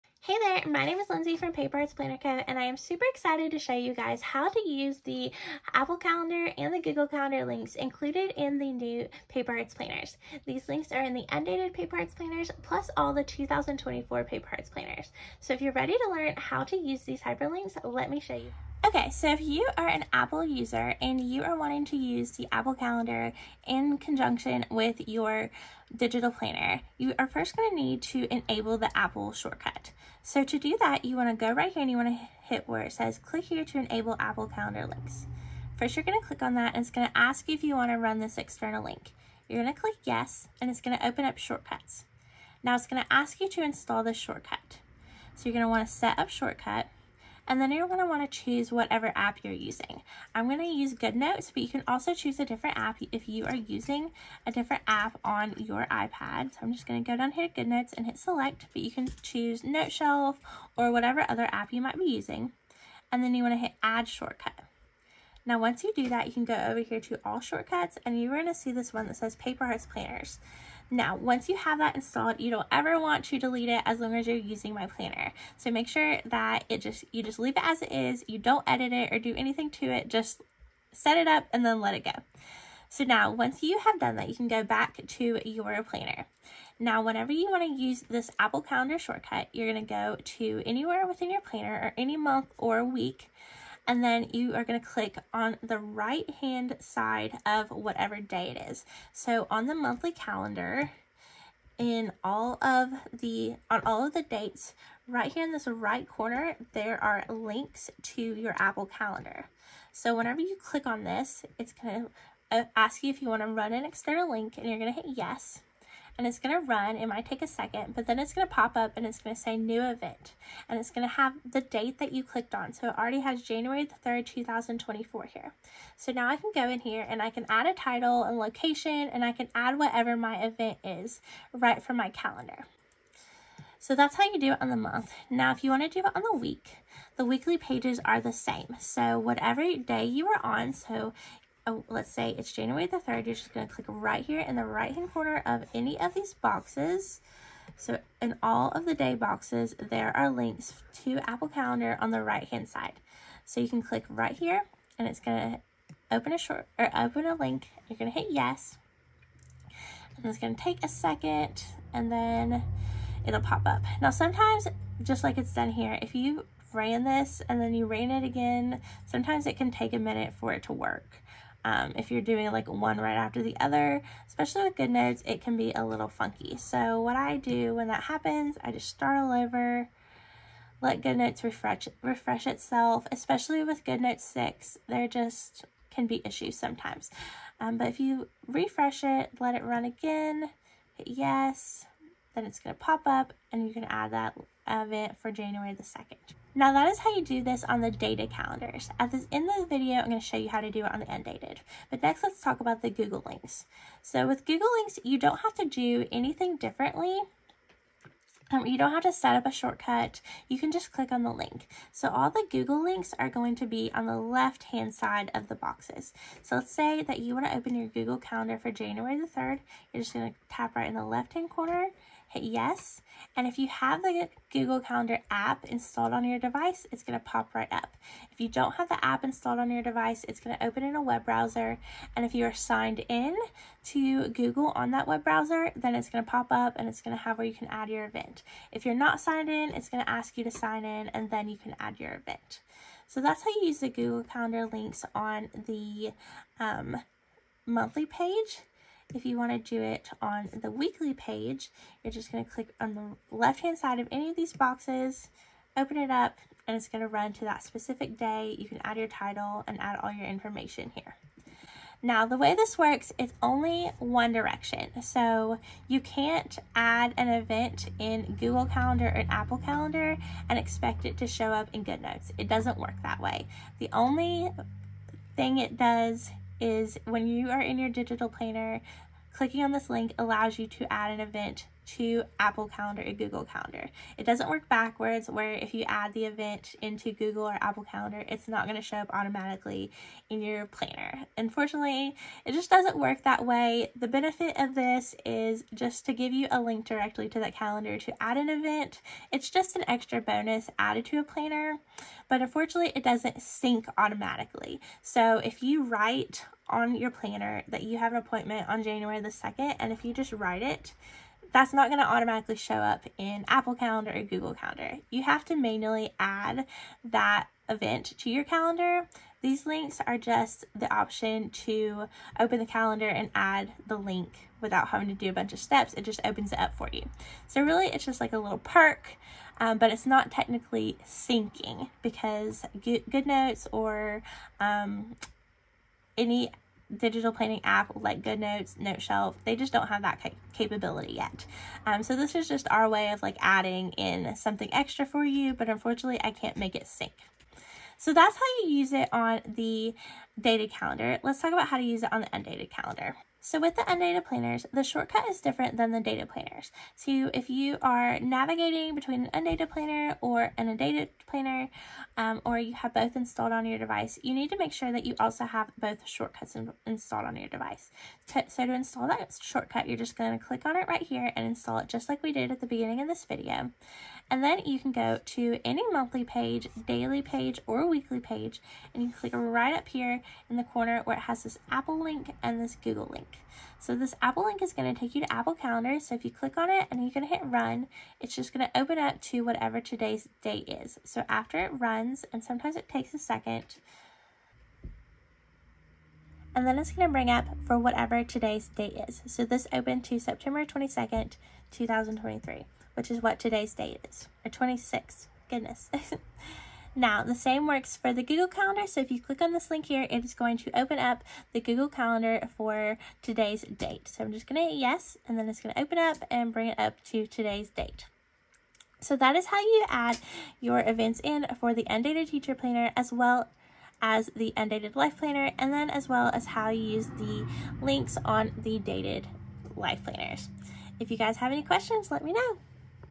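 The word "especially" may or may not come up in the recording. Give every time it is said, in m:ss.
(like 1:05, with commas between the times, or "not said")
2:54, 3:03.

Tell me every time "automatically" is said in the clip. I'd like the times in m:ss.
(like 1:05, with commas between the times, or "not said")
4:49, 5:03, 5:12.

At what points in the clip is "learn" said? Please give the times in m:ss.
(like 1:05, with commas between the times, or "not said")
0:16.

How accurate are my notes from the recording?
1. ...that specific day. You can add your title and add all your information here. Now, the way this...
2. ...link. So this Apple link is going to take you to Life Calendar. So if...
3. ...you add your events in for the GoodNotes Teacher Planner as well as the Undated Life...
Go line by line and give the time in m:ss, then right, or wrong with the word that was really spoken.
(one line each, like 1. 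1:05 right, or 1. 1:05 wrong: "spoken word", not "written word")
1. 4:17 right
2. 6:23 wrong: "Apple", not "Life"
3. 6:59 wrong: "Undated", not "GoodNotes".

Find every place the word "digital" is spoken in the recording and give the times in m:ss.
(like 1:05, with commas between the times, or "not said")
0:25, 4:37, 5:36.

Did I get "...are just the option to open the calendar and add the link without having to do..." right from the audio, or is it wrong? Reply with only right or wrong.
right.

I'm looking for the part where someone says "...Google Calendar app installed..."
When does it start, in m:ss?
3:44.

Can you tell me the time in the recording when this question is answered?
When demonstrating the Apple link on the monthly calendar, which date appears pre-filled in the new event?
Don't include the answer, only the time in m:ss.
2:03.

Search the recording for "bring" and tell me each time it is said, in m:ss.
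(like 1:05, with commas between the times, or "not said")
6:37, 6:56.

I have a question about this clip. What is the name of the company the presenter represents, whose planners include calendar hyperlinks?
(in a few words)
Paper Hearts Planner Co.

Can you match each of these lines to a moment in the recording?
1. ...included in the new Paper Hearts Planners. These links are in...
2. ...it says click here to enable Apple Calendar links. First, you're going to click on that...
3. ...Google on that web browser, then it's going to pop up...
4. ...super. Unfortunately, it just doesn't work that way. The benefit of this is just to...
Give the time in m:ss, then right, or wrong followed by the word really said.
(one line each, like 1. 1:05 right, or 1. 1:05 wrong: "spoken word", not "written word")
1. 0:07 right
2. 0:32 right
3. 3:54 right
4. 4:50 wrong: "planner", not "super".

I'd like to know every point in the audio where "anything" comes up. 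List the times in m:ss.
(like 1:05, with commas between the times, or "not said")
1:19, 3:26.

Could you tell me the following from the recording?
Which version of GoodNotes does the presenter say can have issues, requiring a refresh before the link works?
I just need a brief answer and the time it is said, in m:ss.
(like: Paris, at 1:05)
GoodNotes 6, at 3:03.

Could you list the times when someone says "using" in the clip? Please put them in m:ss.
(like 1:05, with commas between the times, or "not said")
0:49, 0:53, 1:02, 1:14.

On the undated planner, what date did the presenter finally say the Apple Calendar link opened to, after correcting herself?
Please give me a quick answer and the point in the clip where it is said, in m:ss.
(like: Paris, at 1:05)
September 26th, 2023, at 6:44.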